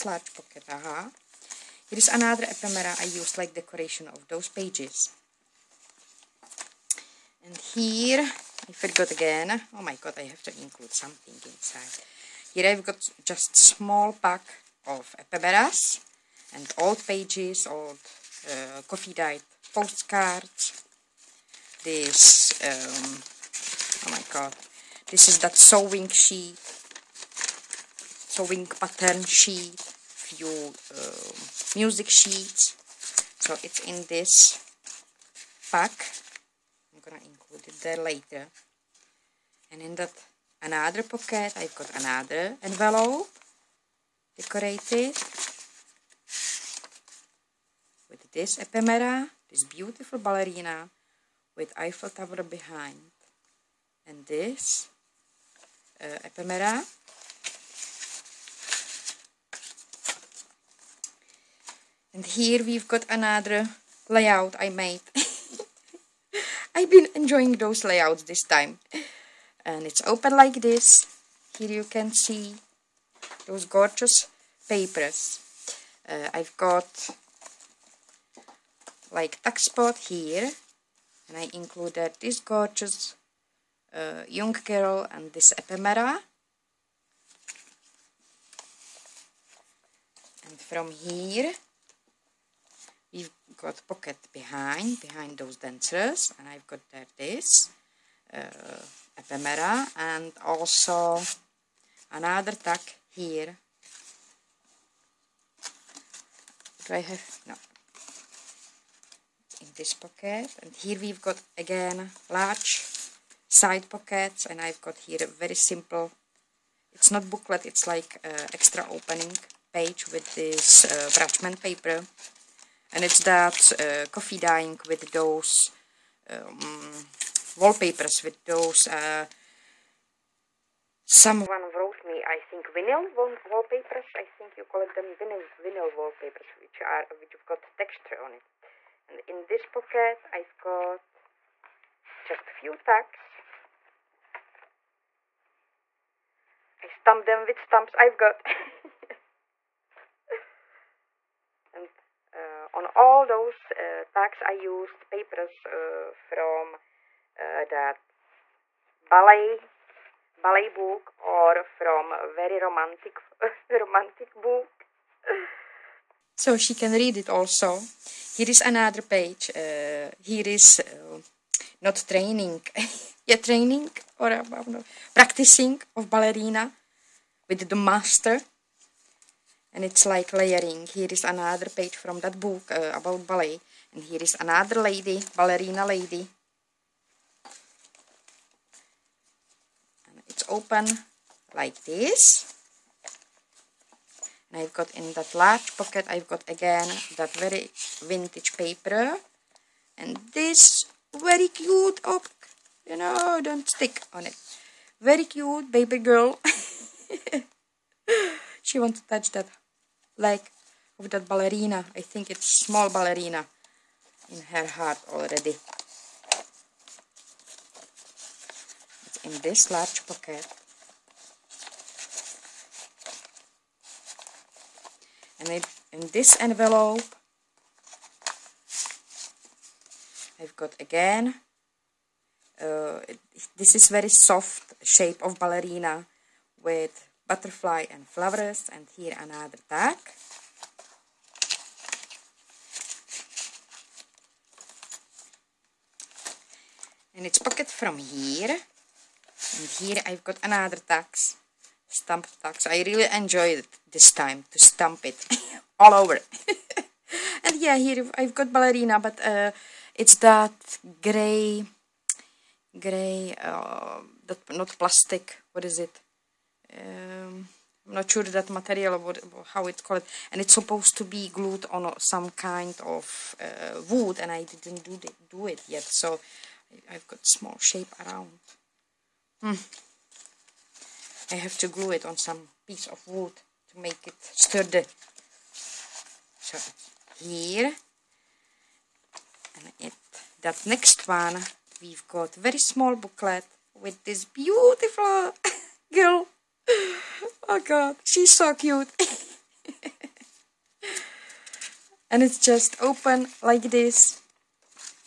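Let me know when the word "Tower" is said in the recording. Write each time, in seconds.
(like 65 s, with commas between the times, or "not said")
52 s.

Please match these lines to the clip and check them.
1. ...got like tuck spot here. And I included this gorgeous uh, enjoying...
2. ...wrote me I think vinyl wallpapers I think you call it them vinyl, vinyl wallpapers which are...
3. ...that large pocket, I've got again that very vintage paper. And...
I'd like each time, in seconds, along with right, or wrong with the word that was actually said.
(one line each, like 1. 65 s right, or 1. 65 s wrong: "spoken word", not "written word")
1. 76 s wrong: "young", not "enjoying"
2. 131 s right
3. 195 s right.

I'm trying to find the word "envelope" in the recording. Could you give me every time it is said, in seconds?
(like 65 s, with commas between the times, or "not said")
42 s, 226 s.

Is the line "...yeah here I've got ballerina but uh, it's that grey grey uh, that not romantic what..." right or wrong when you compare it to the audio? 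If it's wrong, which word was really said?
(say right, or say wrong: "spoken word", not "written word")
wrong: "plastic", not "romantic".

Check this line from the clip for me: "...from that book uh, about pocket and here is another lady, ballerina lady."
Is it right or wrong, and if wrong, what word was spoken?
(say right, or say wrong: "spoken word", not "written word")
wrong: "ballet", not "pocket".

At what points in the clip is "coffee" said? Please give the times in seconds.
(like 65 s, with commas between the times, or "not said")
18 s, 124 s.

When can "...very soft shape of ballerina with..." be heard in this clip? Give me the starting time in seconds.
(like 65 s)
233 s.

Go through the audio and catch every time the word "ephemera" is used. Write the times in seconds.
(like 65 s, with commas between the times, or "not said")
2 s, 15 s, 48 s, 56 s, 85 s, 99 s.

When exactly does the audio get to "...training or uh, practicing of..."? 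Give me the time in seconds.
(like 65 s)
173 s.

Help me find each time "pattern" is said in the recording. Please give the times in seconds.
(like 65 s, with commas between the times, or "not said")
28 s.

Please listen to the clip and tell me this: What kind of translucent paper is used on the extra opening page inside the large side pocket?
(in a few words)
parchment paper.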